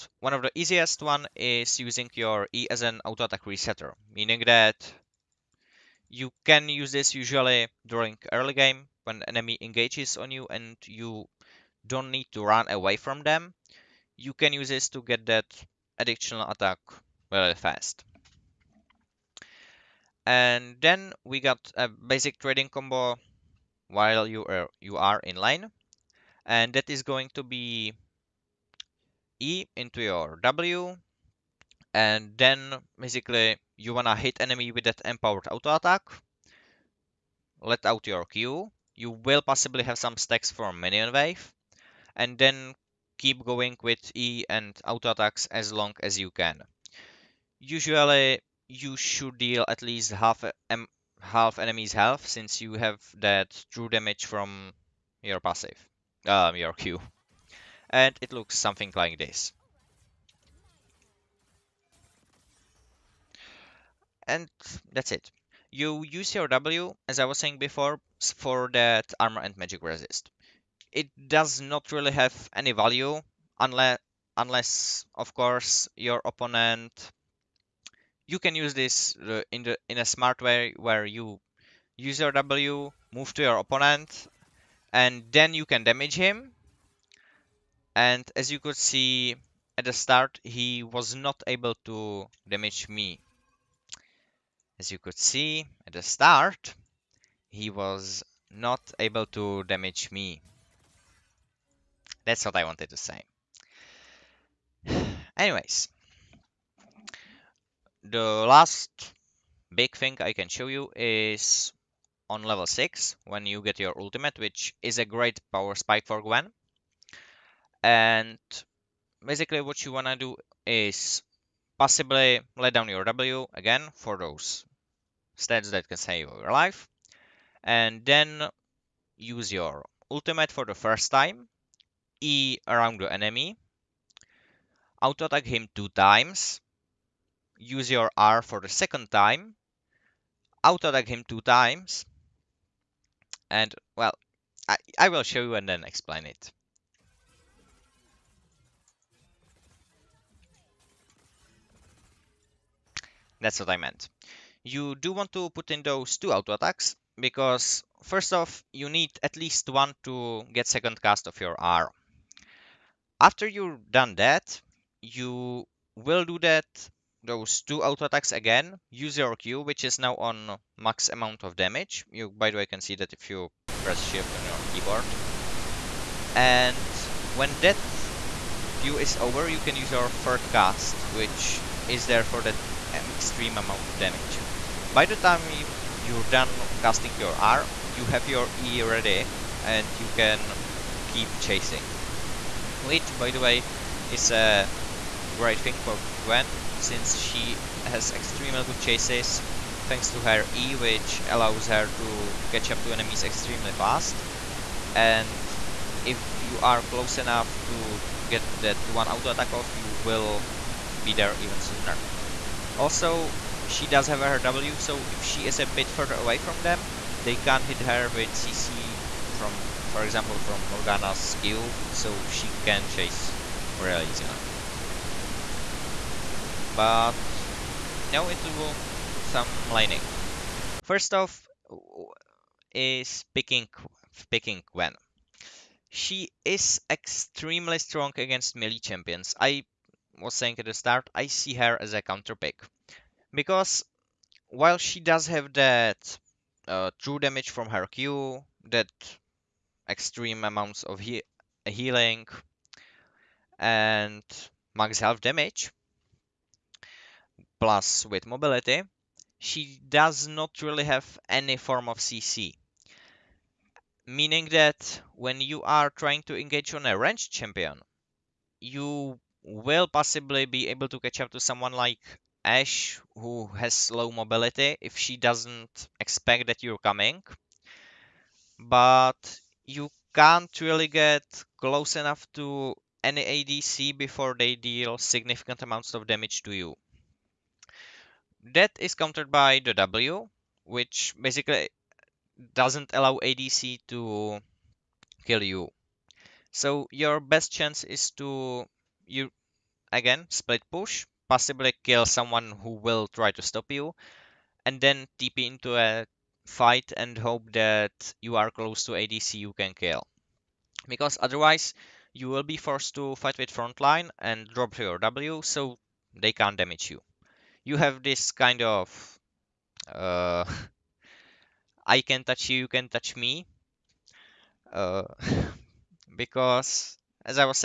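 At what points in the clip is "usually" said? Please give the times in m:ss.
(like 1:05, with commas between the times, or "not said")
0:07, 0:47.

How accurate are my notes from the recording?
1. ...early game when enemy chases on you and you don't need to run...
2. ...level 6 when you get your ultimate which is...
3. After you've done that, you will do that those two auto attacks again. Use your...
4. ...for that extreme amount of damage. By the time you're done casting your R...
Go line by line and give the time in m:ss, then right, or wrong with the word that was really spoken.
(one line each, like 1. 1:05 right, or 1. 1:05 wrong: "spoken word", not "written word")
1. 0:08 wrong: "engages", not "chases"
2. 1:52 right
3. 2:43 right
4. 3:02 right.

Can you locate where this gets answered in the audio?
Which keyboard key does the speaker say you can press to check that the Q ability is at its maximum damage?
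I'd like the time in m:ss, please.
2:54.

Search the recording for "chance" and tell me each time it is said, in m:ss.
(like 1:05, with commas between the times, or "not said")
4:57.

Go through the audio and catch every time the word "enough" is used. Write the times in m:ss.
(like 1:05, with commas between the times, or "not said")
3:27, 4:41.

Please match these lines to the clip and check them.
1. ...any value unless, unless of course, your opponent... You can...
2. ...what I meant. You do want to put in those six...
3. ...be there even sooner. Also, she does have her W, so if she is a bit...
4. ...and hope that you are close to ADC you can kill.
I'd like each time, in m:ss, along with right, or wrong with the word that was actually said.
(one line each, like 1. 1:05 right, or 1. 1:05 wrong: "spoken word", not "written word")
1. 1:12 right
2. 2:33 wrong: "two", not "six"
3. 3:31 right
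4. 5:06 right.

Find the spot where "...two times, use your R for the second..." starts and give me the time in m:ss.
2:15.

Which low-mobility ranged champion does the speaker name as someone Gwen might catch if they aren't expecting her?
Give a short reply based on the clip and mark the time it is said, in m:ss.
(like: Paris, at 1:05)
Ashe, at 4:32.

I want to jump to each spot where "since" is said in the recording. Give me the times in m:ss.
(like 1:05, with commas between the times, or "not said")
0:52, 3:16.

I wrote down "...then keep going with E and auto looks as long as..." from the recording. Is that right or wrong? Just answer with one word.
wrong.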